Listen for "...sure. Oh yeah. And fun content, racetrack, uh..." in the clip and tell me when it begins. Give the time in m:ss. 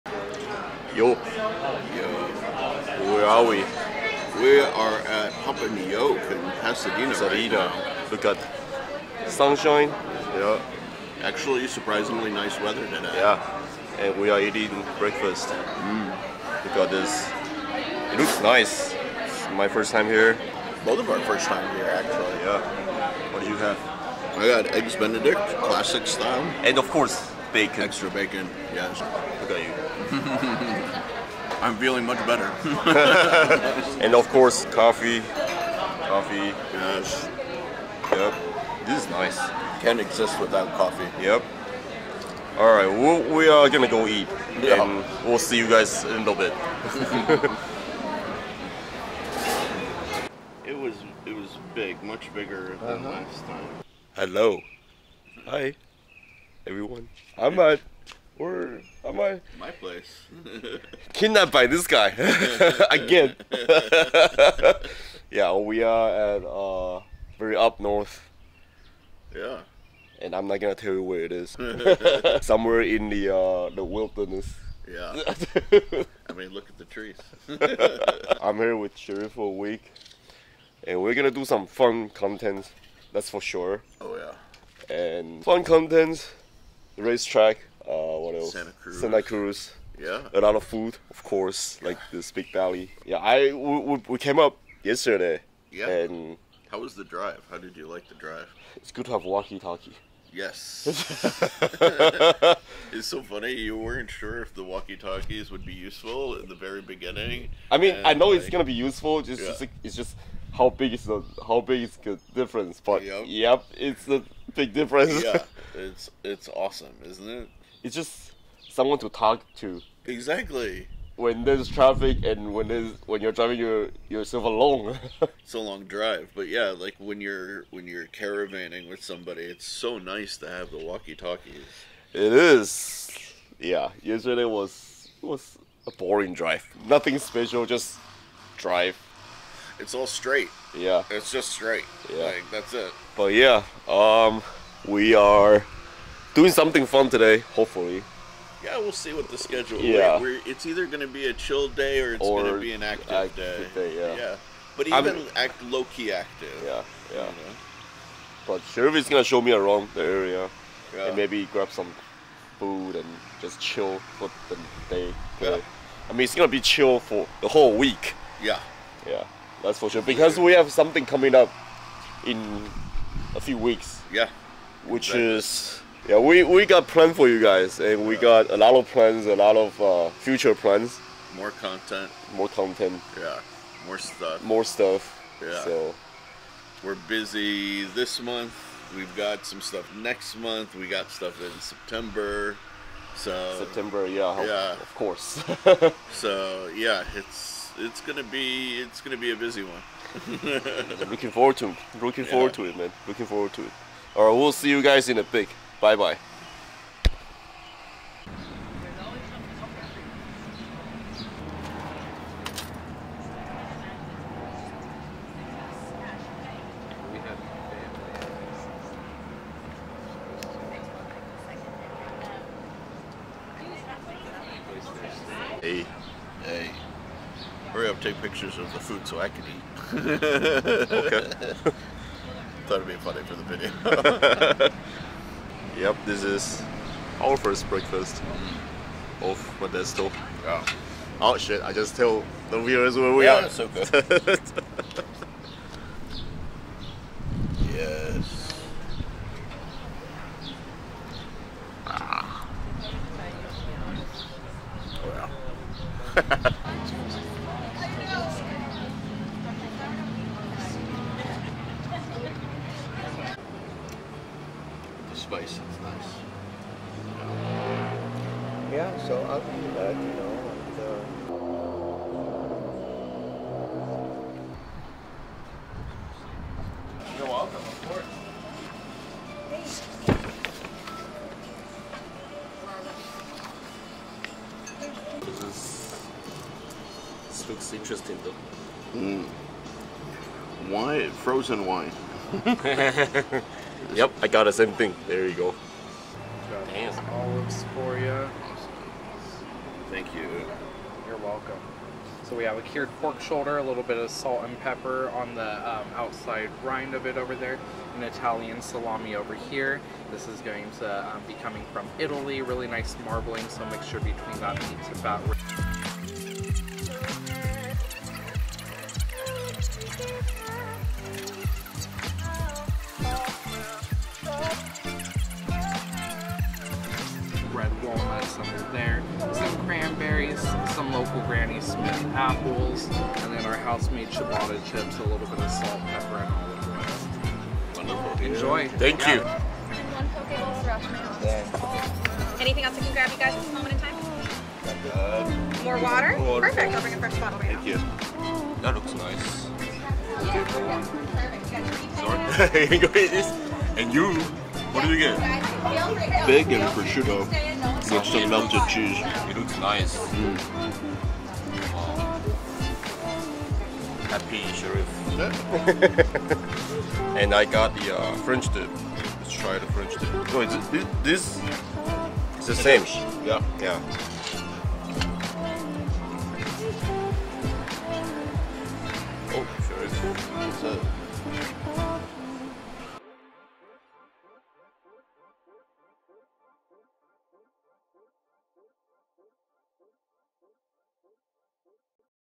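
1:23.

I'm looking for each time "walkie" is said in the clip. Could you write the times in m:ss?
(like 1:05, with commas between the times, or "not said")
1:39, 1:44, 2:10.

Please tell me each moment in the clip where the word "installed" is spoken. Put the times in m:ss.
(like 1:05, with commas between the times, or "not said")
not said.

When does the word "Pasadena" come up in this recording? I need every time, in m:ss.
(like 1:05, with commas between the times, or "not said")
0:06.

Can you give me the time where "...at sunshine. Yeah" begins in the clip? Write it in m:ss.
0:08.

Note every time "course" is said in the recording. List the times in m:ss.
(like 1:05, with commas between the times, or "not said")
0:26, 0:34, 1:31, 3:14, 4:37.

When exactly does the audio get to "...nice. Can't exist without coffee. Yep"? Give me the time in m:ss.
0:39.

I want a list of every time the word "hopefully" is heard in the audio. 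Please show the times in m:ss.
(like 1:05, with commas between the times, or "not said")
2:27.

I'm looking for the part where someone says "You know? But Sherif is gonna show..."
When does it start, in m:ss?
2:37.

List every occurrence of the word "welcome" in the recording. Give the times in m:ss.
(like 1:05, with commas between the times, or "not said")
4:37, 5:01.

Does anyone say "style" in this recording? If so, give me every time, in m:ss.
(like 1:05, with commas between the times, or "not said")
0:26.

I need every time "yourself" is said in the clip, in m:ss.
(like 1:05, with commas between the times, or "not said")
2:04.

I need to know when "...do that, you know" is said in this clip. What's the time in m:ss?
4:29.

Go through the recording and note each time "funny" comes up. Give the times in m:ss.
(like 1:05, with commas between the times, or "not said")
1:43, 3:52.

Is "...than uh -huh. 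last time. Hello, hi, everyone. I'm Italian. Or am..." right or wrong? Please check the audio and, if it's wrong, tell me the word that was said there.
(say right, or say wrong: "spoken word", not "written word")
wrong: "Matt", not "Italian".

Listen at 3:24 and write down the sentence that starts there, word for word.
All right, we'll see you guys in a pic.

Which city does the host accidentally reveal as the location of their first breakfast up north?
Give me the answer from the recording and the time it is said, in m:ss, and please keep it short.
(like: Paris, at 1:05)
Modesto, at 3:59.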